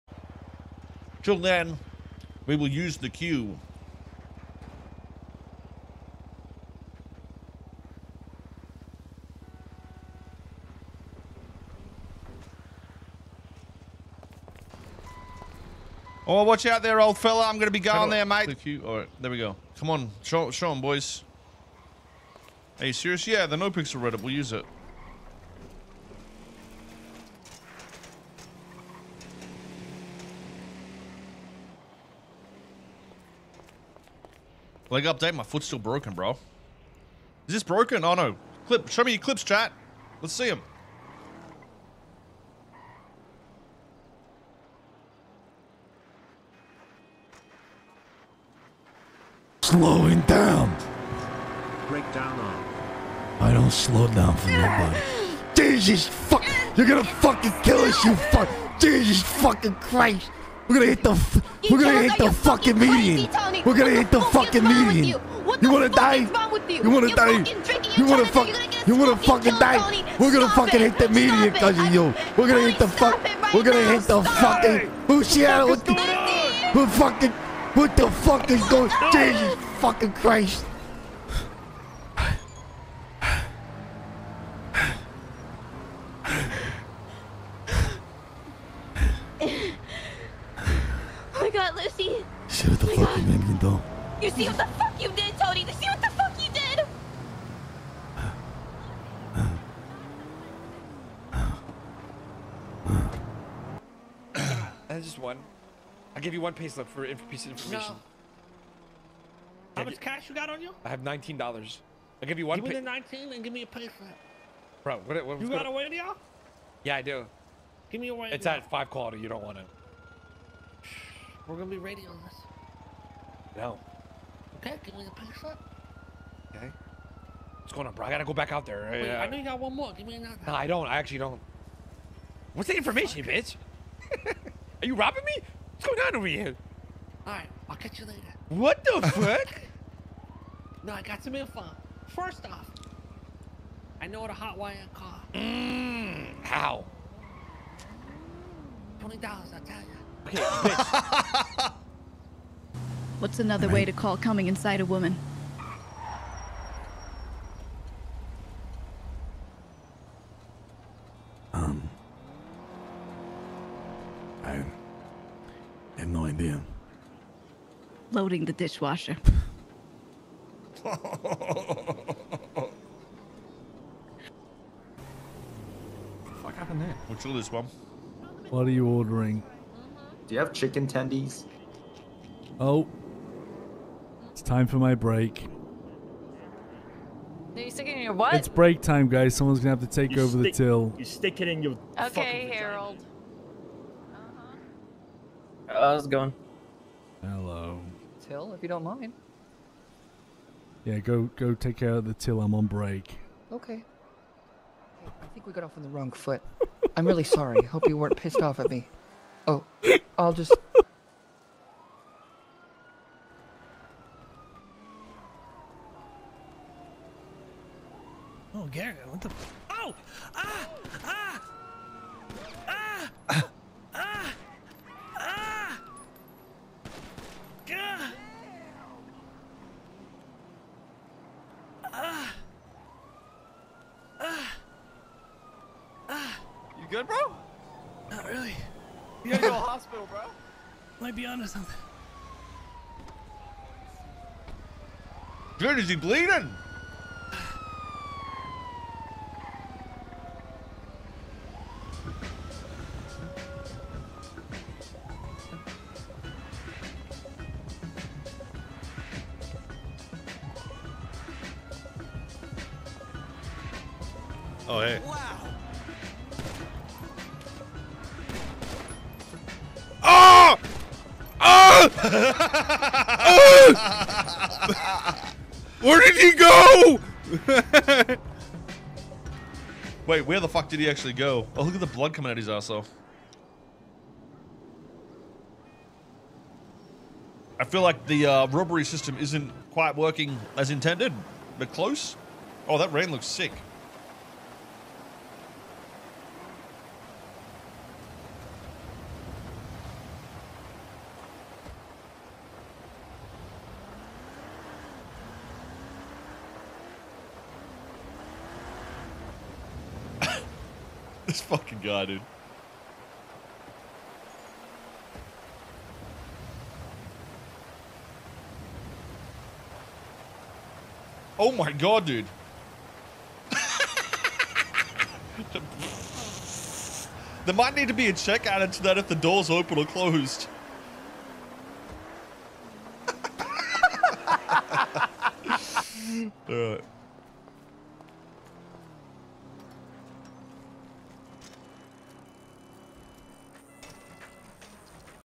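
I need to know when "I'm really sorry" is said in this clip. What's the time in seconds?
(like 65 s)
206 s.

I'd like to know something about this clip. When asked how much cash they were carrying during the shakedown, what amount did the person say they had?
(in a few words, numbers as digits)
$19.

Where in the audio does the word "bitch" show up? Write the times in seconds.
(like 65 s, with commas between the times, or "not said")
133 s, 150 s.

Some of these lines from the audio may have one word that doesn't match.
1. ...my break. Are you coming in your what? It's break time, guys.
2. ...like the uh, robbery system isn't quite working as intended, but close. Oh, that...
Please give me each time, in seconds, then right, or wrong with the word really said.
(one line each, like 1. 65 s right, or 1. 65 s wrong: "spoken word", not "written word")
1. 184 s wrong: "sticking", not "coming"
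2. 287 s right.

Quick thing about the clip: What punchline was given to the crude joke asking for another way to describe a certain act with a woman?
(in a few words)
Loading the dishwasher.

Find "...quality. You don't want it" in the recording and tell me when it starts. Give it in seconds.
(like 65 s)
118 s.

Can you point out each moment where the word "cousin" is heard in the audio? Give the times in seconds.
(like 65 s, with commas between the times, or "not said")
71 s.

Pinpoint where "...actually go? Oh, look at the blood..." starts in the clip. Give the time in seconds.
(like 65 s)
280 s.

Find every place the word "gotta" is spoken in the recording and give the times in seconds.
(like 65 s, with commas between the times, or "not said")
128 s, 239 s.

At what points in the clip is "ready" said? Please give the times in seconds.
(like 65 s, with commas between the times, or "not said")
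24 s, 121 s.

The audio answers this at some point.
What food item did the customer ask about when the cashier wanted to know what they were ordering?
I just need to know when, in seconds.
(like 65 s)
180 s.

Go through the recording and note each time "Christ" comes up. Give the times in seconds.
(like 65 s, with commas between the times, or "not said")
59 s, 80 s.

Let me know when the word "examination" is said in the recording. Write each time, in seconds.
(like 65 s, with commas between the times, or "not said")
not said.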